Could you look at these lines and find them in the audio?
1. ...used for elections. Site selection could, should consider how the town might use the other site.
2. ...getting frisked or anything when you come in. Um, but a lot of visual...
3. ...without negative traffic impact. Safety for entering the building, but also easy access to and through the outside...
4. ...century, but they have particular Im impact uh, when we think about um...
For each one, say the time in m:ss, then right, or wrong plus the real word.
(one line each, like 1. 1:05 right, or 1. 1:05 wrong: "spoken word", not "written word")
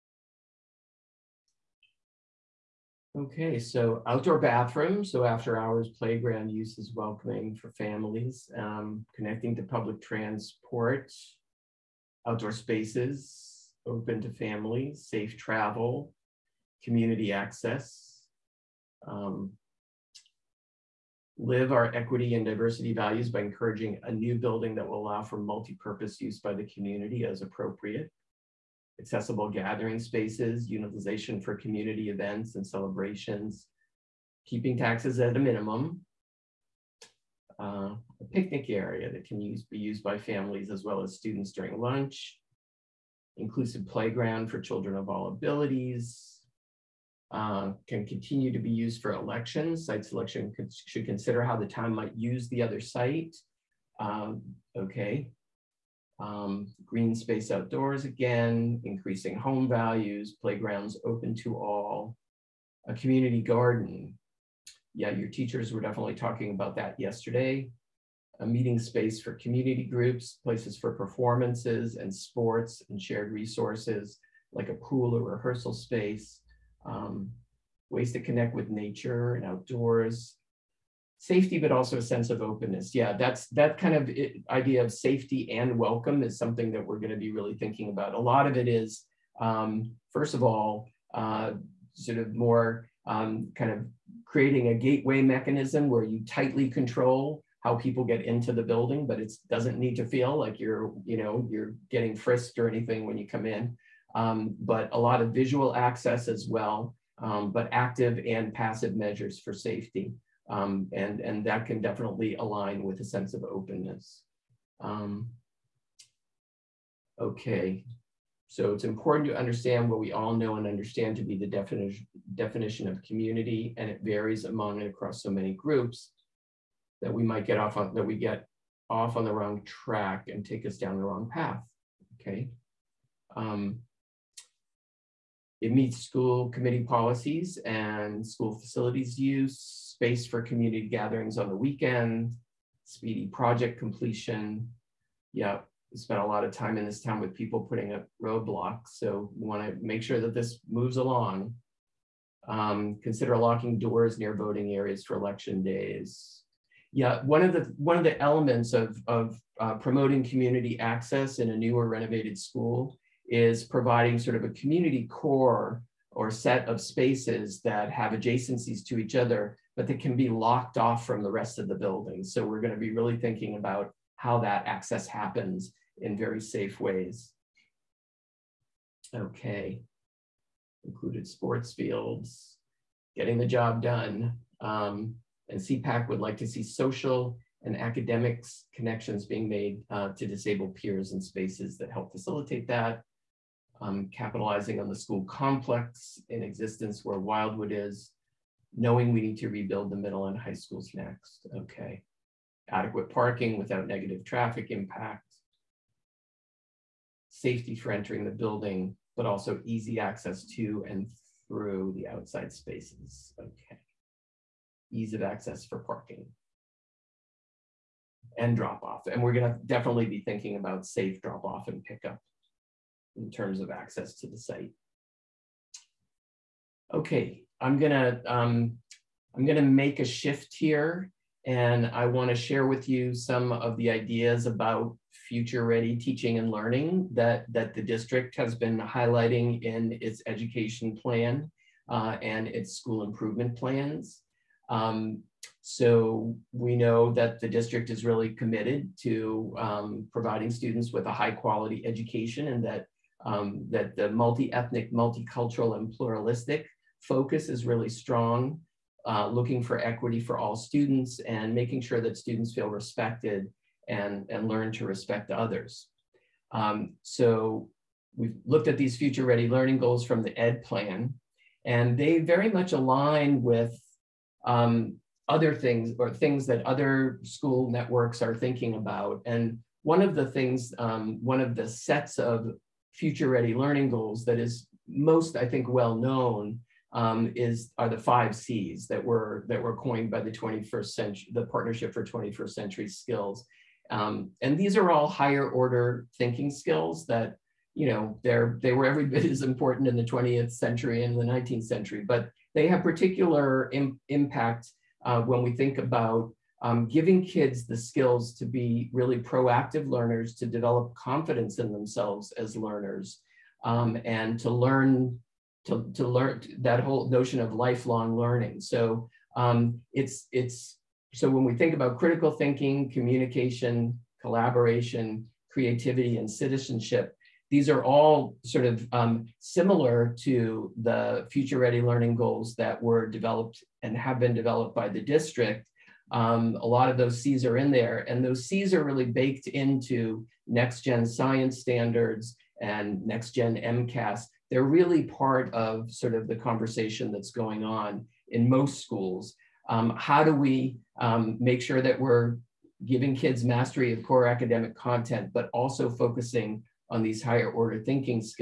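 1. 0:48 right
2. 1:41 right
3. 3:23 right
4. 5:01 right.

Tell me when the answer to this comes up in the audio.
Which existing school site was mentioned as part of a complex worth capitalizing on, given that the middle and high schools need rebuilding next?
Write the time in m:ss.
3:17.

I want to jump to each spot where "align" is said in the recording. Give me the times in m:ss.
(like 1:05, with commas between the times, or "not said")
1:52, 4:32.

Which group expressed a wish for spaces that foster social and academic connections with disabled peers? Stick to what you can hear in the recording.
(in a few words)
SEPAC.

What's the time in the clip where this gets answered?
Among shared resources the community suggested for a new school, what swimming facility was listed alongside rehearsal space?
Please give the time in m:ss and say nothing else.
1:14.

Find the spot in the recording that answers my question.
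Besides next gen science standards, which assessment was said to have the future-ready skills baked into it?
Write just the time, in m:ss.
5:43.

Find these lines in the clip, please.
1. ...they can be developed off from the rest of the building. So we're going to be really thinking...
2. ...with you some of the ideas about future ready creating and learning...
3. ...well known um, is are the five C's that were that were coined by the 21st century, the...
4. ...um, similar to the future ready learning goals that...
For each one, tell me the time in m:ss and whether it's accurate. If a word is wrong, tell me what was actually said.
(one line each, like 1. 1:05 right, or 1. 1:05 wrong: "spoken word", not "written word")
1. 2:49 wrong: "locked", not "developed"
2. 3:52 wrong: "teaching", not "creating"
3. 4:45 right
4. 5:28 right.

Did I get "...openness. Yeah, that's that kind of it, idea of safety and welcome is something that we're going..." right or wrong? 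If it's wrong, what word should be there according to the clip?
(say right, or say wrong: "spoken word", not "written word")
right.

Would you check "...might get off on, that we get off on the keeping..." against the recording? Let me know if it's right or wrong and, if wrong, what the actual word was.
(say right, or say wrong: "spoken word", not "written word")
wrong: "wrong", not "keeping".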